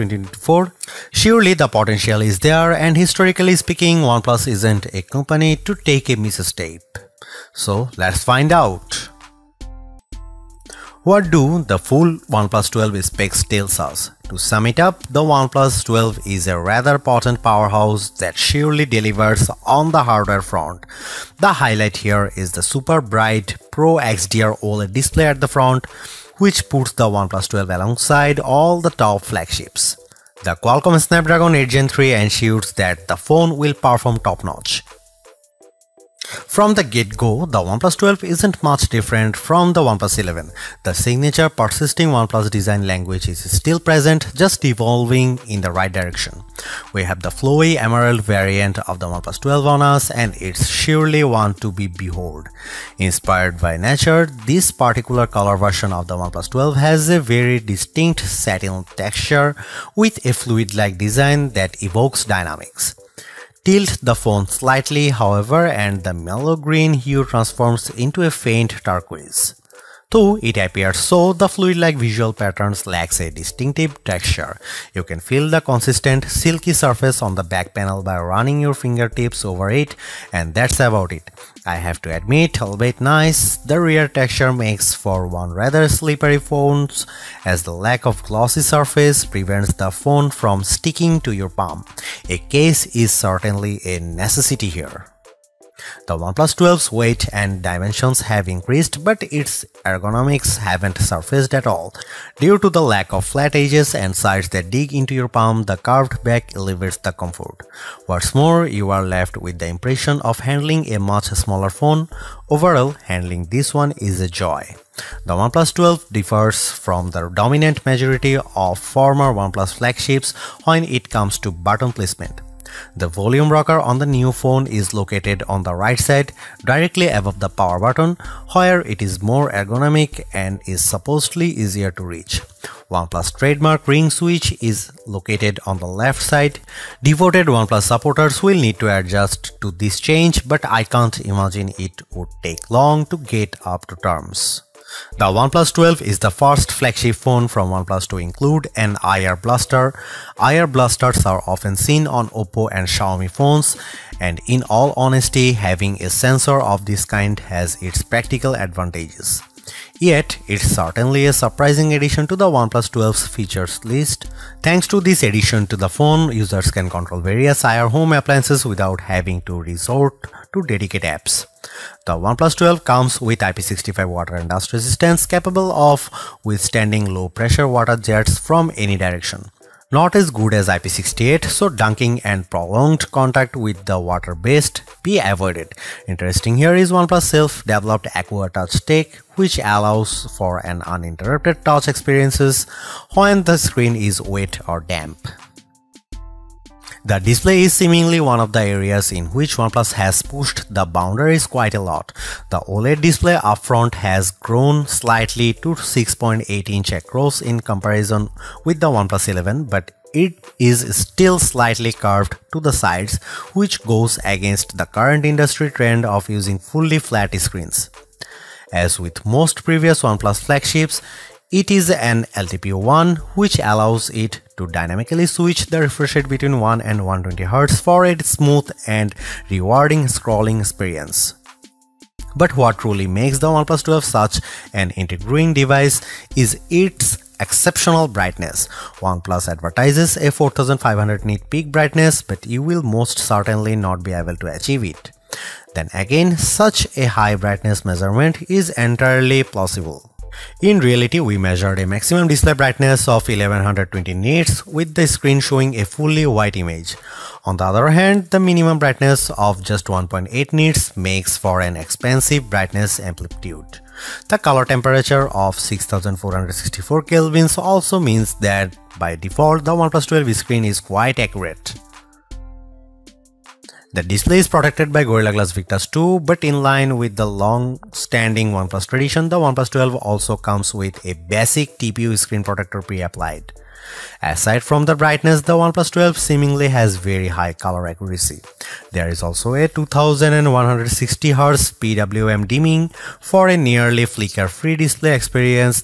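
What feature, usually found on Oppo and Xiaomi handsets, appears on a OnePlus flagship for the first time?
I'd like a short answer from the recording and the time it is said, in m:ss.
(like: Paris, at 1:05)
IR blaster, at 2:29.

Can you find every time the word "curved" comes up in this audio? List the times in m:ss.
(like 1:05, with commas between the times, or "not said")
1:45, 3:31.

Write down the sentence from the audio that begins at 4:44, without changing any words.
Aside from the brightness, the OnePlus 12 seemingly has very high color accuracy.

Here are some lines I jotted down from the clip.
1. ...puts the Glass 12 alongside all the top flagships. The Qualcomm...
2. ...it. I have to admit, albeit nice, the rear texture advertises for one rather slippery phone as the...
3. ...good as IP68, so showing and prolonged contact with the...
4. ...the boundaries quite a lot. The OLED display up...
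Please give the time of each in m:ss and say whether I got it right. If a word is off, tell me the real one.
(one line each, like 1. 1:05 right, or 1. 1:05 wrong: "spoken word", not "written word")
1. 0:26 wrong: "OnePlus", not "Glass"
2. 1:21 wrong: "makes", not "advertises"
3. 3:00 wrong: "dunking", not "showing"
4. 3:20 right.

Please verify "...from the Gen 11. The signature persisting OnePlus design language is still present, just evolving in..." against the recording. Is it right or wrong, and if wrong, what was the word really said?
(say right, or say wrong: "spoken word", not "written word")
wrong: "OnePlus", not "Gen".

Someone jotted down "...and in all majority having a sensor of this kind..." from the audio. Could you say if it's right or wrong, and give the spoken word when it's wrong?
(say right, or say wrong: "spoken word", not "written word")
wrong: "honesty", not "majority".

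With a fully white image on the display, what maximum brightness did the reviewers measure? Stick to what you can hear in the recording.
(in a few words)
1120 nits.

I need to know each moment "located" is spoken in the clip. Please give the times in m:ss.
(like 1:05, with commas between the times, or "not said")
2:04, 2:15.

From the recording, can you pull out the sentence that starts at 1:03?
Tilt the phone slightly however and the mellow green hue transforms into a faint turquoise.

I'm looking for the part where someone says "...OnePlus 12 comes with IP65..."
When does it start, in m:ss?
2:52.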